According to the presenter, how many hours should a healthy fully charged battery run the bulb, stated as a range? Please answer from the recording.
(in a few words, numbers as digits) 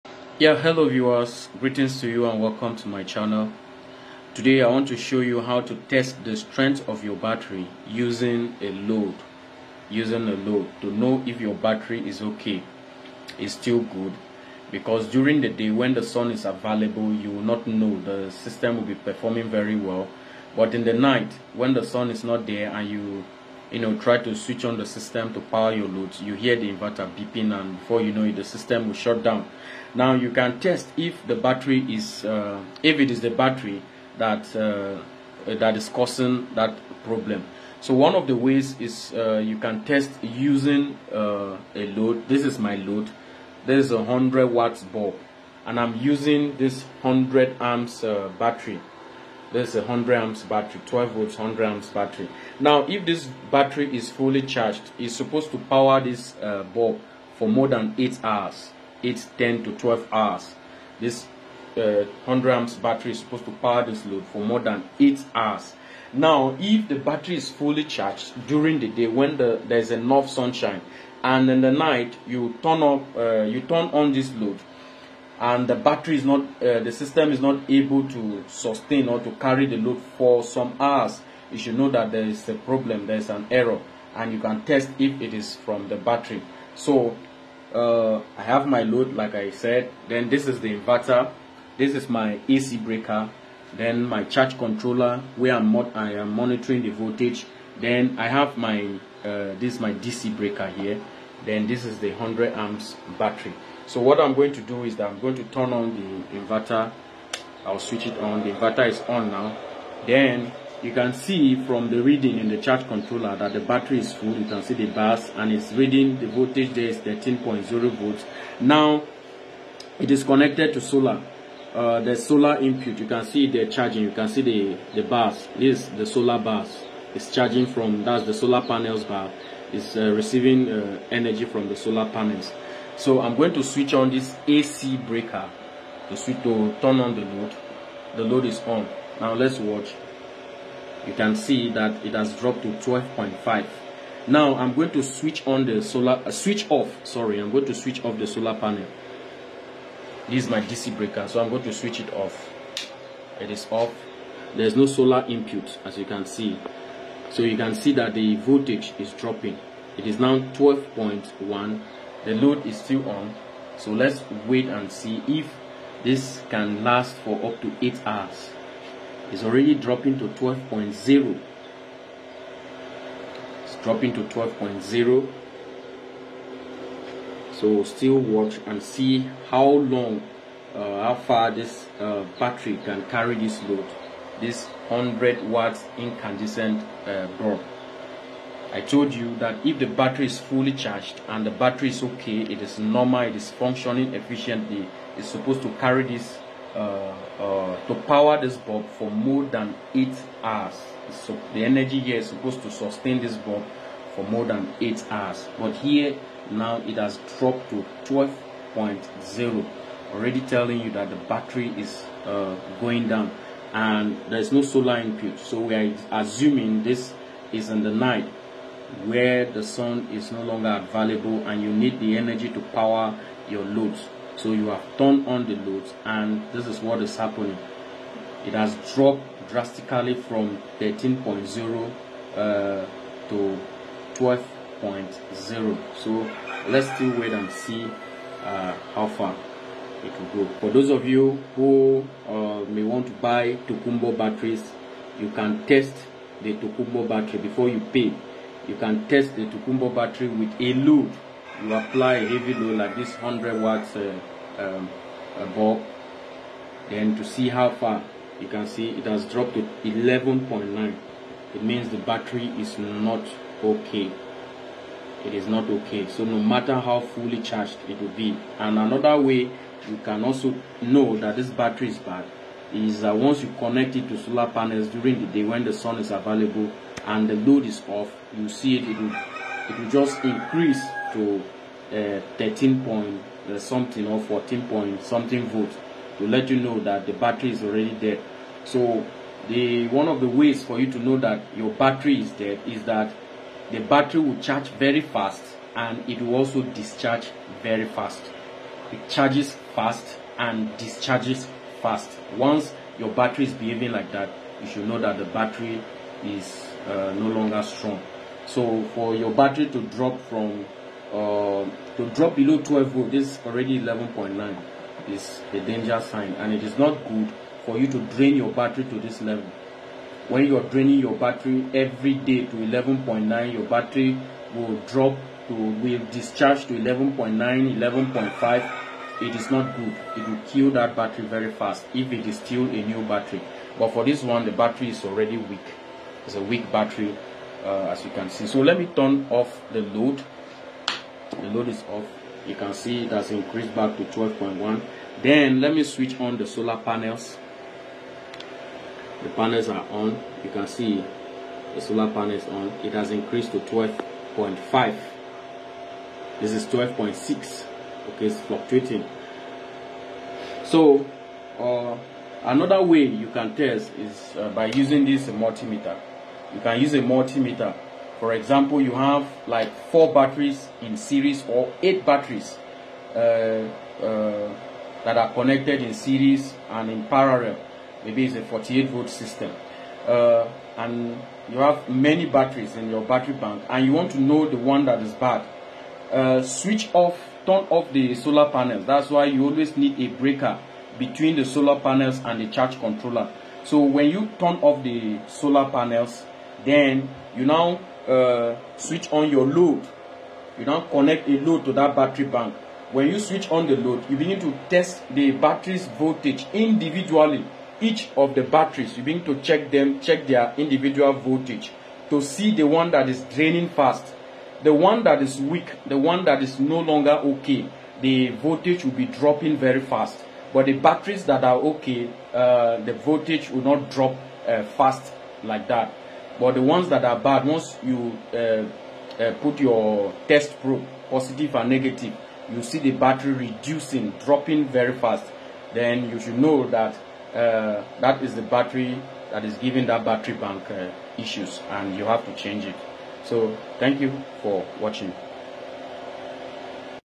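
10 to 12 hours.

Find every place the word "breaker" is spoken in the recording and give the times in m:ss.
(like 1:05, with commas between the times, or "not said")
1:32, 1:40, 2:14, 2:30, 6:30.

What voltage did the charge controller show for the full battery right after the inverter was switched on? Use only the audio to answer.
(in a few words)
13.0 volts.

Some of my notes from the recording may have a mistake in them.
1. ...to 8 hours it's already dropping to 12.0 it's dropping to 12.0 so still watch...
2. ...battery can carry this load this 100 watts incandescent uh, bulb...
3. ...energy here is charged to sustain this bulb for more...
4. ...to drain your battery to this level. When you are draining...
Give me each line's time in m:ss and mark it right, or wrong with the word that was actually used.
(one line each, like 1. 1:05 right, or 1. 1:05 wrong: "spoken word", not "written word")
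1. 2:47 right
2. 3:02 right
3. 3:21 wrong: "supposed", not "charged"
4. 5:17 right.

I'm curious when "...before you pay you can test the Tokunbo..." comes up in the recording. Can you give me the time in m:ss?
4:07.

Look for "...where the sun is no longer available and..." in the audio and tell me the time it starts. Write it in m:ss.
3:39.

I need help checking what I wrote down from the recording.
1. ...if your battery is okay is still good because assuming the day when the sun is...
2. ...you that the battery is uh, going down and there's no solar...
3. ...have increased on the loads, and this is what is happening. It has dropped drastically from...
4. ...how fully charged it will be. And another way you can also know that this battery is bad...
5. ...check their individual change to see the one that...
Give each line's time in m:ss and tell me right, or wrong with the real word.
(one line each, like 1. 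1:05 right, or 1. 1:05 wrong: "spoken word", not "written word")
1. 0:11 wrong: "during", not "assuming"
2. 3:30 right
3. 3:44 wrong: "turned", not "increased"
4. 4:26 right
5. 6:50 wrong: "voltage", not "change".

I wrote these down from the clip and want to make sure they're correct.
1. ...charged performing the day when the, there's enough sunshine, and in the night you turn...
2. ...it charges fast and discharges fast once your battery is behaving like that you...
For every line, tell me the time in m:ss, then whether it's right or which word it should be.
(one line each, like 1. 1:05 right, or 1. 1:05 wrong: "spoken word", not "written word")
1. 1:07 wrong: "during", not "performing"
2. 4:58 right.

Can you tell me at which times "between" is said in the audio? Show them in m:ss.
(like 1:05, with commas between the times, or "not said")
6:30.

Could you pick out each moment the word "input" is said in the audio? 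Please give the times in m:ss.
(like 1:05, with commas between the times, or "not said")
2:02, 2:35, 3:34.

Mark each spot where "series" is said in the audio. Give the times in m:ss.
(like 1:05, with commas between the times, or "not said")
6:10, 6:15.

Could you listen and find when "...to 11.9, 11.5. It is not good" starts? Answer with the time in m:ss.
5:26.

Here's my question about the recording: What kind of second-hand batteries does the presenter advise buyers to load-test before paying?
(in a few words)
Tokunbo batteries.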